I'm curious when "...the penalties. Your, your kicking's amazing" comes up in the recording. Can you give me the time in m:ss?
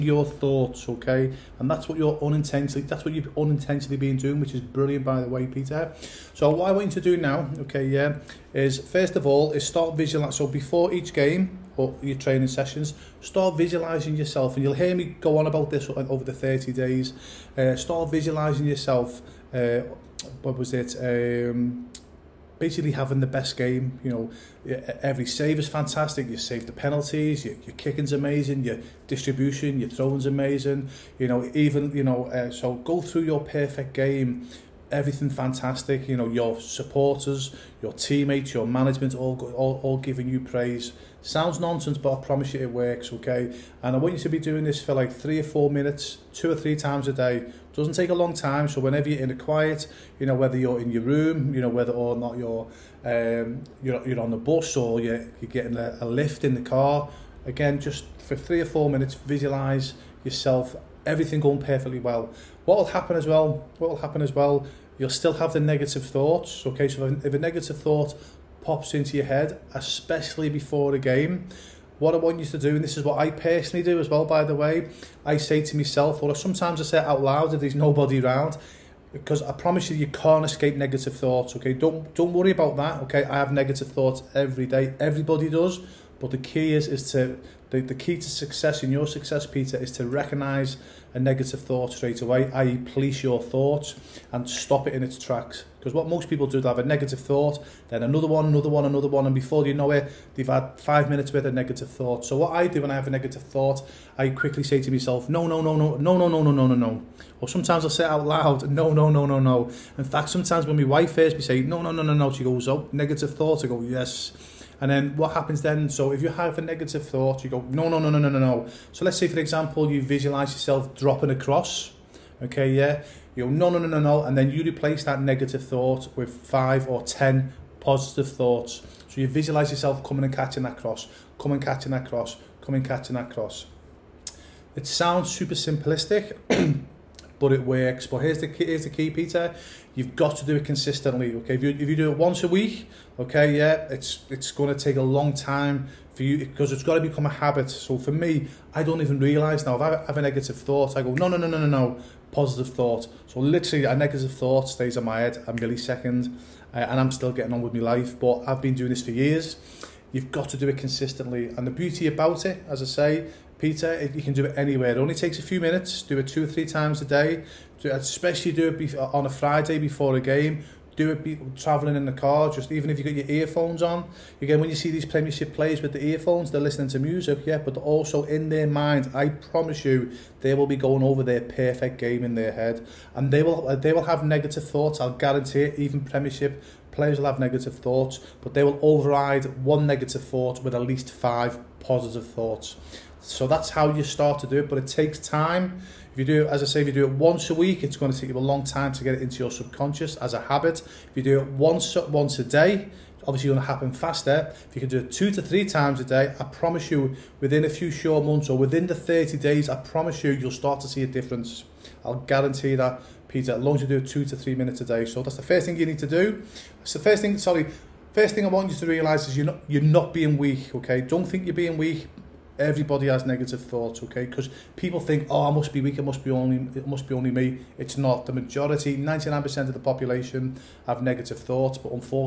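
0:26.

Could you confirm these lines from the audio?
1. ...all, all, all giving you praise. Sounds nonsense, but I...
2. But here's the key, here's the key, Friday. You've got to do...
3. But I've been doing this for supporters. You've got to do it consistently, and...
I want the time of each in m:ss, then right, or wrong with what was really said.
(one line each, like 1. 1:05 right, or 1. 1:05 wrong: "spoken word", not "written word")
1. 0:39 right
2. 2:18 wrong: "Peter", not "Friday"
3. 2:38 wrong: "years", not "supporters".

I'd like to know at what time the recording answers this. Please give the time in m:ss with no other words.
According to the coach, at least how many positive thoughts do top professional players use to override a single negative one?
3:10.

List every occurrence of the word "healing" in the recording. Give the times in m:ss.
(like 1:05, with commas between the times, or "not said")
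not said.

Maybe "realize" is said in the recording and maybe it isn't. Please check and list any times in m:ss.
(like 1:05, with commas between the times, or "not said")
2:29, 3:38.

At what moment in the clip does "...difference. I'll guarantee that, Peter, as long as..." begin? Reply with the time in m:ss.
3:31.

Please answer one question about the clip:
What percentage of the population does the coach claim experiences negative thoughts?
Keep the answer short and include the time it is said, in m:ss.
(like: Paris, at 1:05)
99%, at 3:48.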